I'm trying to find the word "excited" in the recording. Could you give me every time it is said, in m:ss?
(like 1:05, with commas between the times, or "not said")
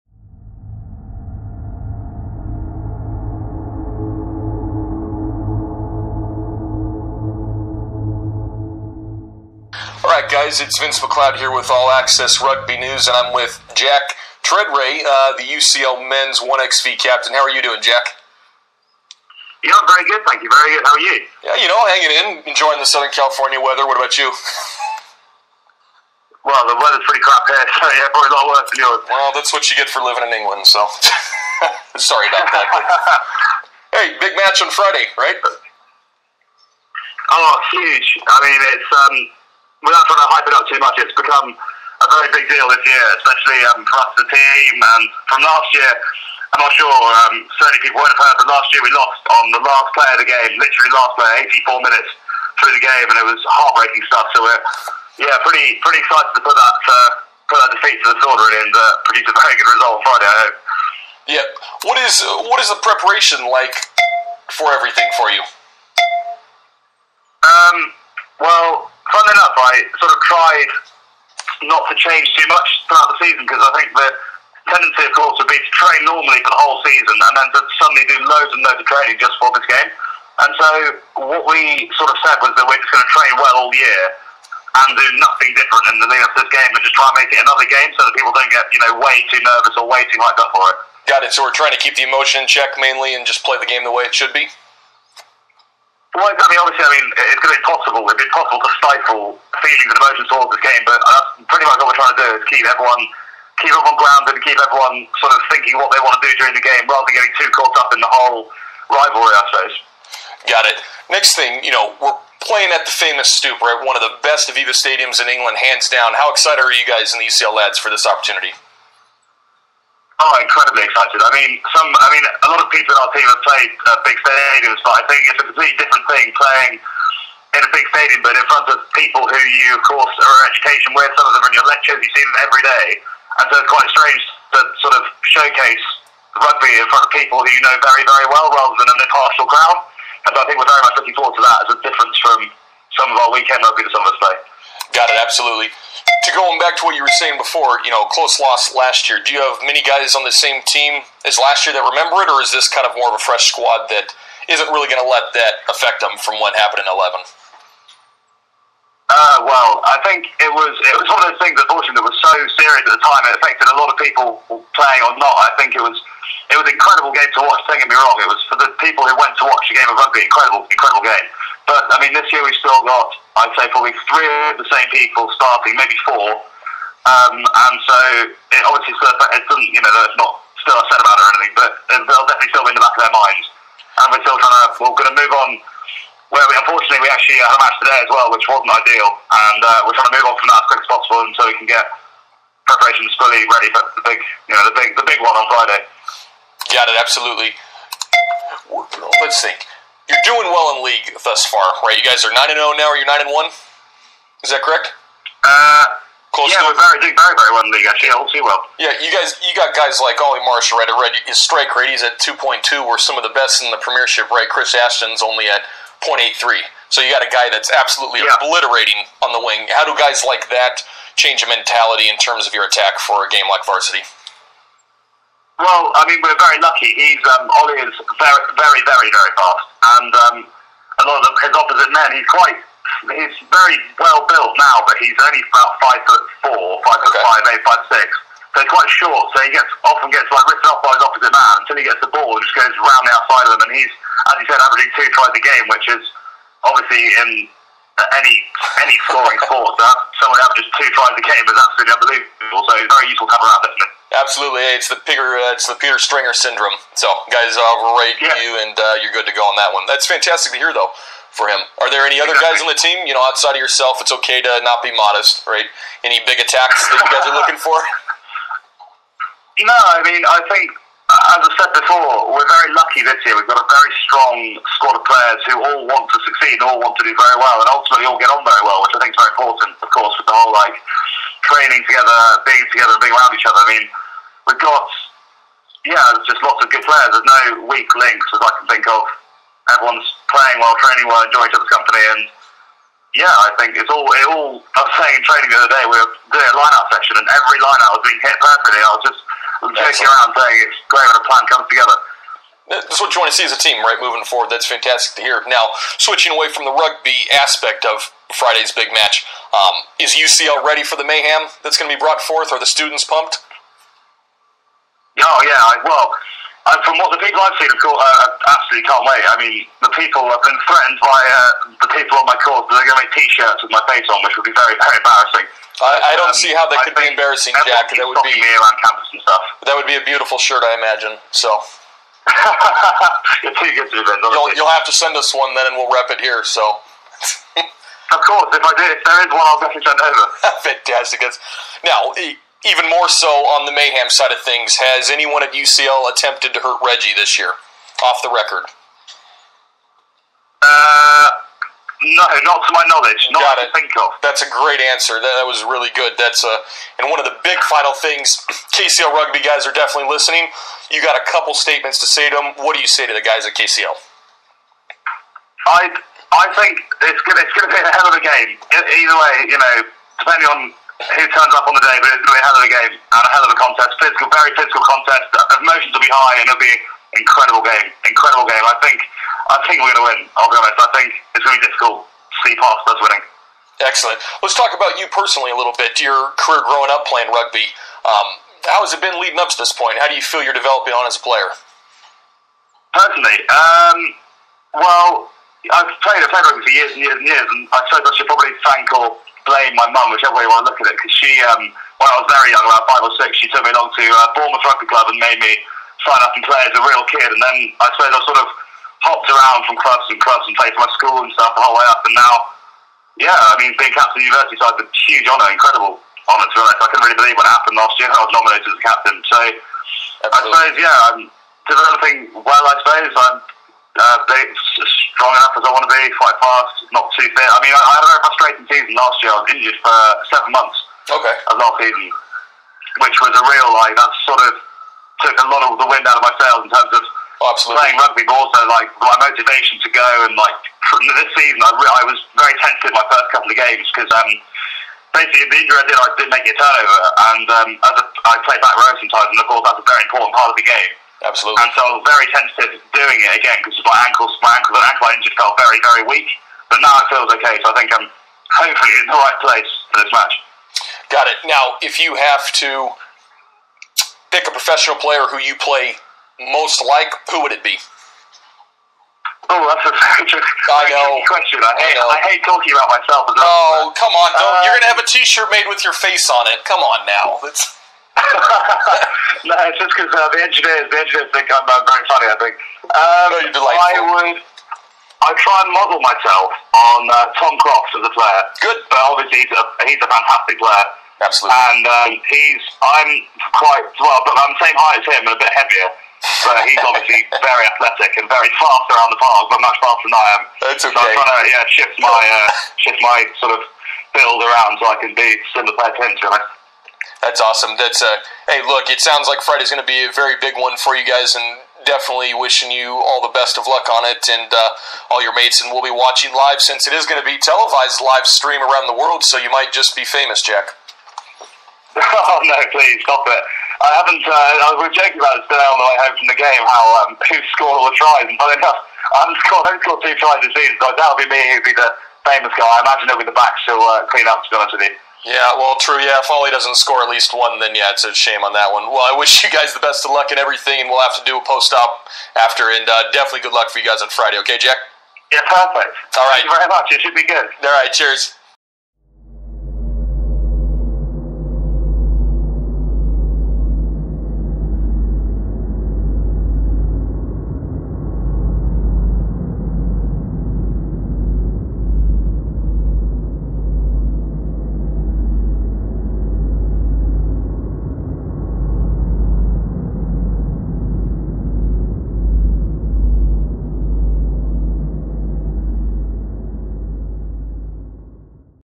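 0:56, 1:56, 2:00.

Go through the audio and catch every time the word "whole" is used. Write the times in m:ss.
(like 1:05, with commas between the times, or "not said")
1:16, 1:48, 4:40, 6:51.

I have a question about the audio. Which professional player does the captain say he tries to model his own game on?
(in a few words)
Tom Crofts.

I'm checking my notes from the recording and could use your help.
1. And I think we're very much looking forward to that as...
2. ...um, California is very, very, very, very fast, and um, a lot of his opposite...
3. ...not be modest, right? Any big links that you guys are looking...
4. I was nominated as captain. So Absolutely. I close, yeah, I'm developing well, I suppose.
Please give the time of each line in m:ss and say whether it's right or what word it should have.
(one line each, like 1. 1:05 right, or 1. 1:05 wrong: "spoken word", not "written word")
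1. 2:20 right
2. 3:47 wrong: "Ollie", not "California"
3. 4:24 wrong: "attacks", not "links"
4. 6:58 wrong: "suppose", not "close".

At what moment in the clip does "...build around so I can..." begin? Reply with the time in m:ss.
8:24.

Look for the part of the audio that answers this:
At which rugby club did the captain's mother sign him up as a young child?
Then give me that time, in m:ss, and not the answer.
6:44.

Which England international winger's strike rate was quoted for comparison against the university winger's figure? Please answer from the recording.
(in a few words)
Chris Ashton.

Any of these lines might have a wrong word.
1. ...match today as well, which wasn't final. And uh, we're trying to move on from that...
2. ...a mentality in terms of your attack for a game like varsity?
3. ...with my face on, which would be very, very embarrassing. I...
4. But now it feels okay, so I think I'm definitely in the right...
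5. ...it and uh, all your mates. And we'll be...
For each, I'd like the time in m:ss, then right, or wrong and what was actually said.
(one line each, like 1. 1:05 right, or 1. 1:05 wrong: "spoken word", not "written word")
1. 3:07 wrong: "ideal", not "final"
2. 3:41 right
3. 5:23 right
4. 7:36 wrong: "hopefully", not "definitely"
5. 8:34 right.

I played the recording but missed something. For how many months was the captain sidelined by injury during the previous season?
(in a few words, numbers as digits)
7.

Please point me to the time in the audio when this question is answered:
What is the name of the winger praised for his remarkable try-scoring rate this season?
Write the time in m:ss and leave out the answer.
3:30.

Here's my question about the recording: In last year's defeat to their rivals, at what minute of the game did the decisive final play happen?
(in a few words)
84.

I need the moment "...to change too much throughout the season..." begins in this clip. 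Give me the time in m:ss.
1:11.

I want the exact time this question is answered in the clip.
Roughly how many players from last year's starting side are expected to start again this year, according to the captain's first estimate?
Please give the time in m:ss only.
2:54.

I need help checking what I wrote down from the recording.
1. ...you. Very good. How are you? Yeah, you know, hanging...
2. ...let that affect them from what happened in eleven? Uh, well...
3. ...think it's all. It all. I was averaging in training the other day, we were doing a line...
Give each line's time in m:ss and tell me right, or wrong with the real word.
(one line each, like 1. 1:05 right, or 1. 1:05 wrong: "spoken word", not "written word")
1. 0:20 right
2. 2:35 right
3. 4:53 wrong: "saying", not "averaging".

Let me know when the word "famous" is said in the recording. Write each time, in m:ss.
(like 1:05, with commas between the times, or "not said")
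1:52, 8:40, 8:52.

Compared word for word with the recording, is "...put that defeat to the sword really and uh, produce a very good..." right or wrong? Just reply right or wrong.
right.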